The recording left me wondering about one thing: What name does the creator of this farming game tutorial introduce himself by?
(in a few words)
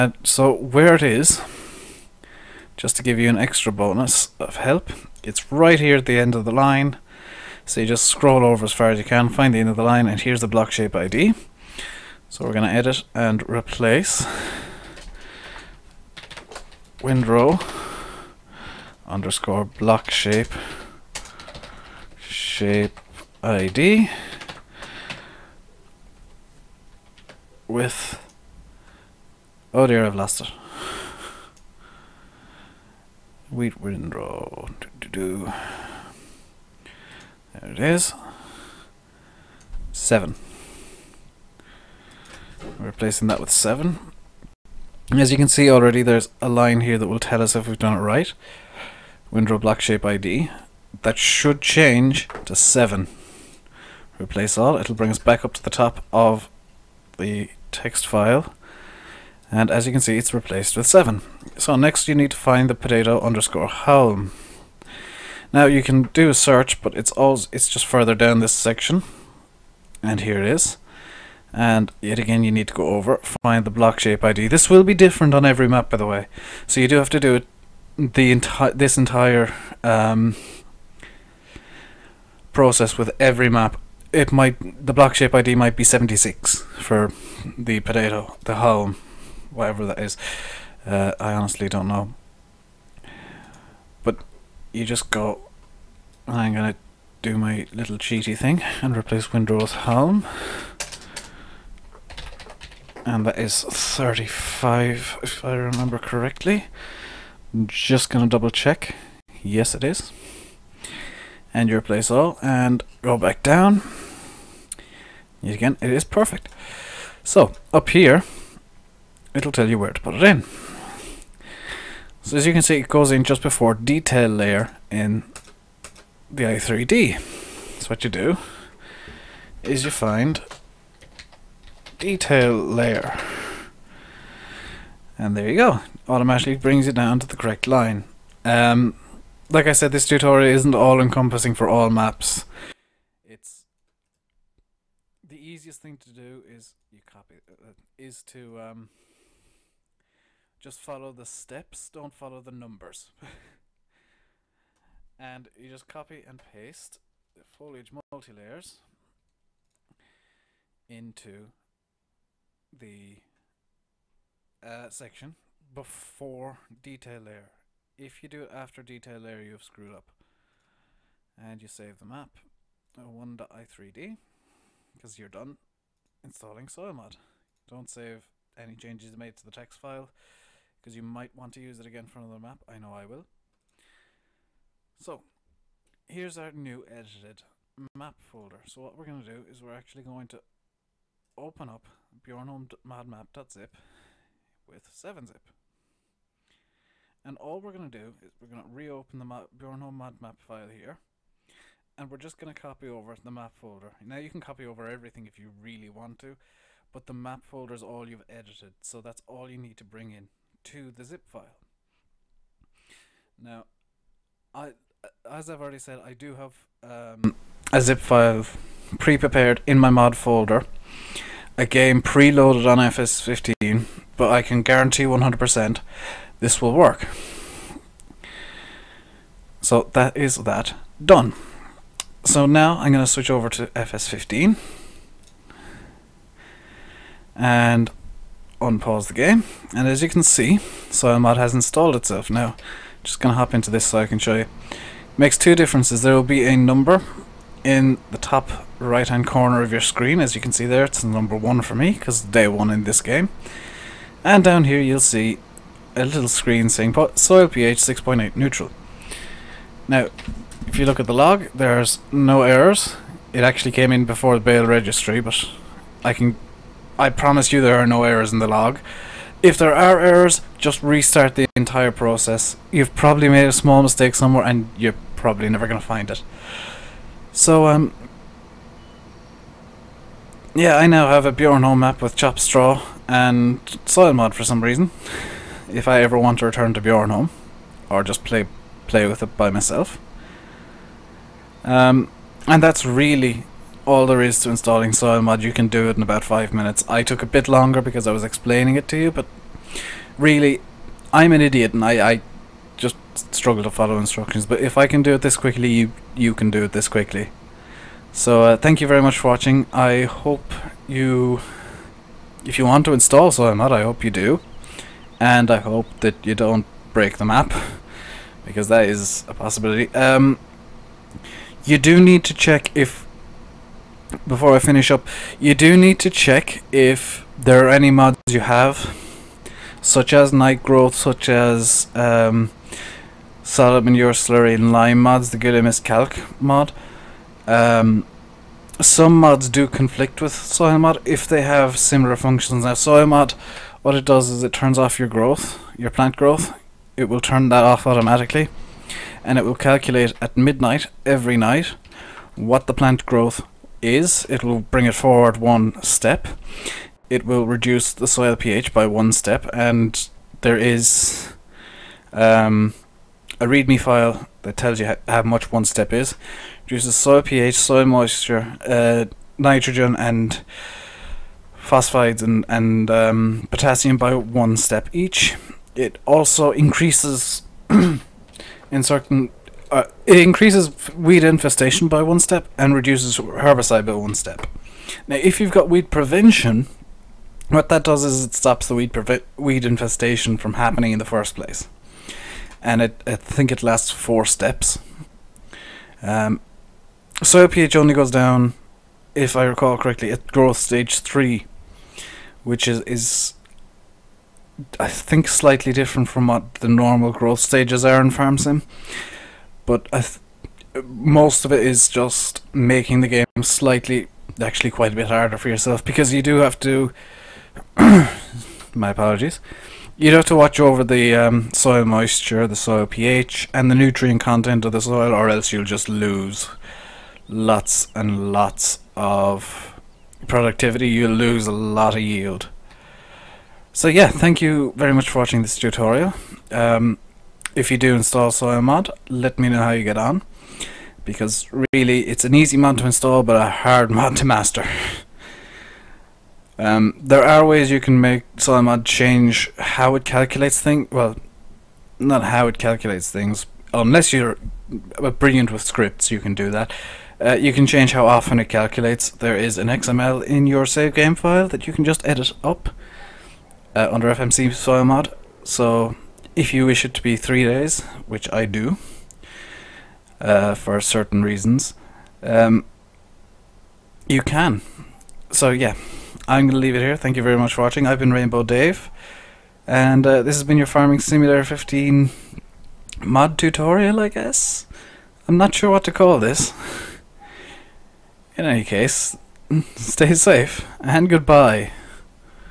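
Rainbow Dave.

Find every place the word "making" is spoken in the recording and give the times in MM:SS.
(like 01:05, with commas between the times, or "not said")
06:52.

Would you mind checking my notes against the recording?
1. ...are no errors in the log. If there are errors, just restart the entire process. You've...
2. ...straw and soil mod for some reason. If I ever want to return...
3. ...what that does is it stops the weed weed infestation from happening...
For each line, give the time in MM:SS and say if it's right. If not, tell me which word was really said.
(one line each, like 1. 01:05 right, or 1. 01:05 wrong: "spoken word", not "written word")
1. 04:27 right
2. 04:42 right
3. 06:27 right.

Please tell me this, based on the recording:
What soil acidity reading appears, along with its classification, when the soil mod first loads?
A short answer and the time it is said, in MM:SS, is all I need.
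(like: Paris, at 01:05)
6.8, at 04:17.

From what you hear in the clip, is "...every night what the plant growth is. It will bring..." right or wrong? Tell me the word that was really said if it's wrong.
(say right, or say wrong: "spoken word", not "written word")
right.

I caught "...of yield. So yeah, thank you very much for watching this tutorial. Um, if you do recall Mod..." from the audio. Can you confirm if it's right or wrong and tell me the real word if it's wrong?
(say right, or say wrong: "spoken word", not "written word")
wrong: "install", not "recall".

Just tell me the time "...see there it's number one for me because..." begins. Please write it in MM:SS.
04:10.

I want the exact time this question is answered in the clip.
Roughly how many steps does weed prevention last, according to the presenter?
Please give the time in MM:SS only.
06:33.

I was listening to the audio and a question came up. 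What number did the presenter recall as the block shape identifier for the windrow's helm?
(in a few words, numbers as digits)
35.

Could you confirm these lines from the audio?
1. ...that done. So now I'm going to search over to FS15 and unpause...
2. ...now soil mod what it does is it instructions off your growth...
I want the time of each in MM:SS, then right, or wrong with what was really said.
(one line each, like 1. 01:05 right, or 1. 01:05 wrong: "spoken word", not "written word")
1. 03:50 wrong: "switch", not "search"
2. 05:42 wrong: "turns", not "instructions".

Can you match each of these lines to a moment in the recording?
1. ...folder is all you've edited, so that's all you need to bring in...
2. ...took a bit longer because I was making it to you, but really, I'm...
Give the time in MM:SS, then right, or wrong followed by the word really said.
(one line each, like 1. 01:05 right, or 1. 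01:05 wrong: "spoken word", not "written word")
1. 03:27 right
2. 04:57 wrong: "explaining", not "making".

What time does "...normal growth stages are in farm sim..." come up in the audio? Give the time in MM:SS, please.
06:46.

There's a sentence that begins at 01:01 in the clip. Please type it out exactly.
So next you need to find the potato underscore home.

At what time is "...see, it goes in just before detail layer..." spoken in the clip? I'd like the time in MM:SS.
02:02.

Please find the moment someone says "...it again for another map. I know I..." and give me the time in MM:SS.
03:01.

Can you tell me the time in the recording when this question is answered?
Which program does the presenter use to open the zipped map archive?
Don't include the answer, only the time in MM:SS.
03:14.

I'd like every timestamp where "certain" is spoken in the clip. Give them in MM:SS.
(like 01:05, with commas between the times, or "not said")
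06:18, 07:50.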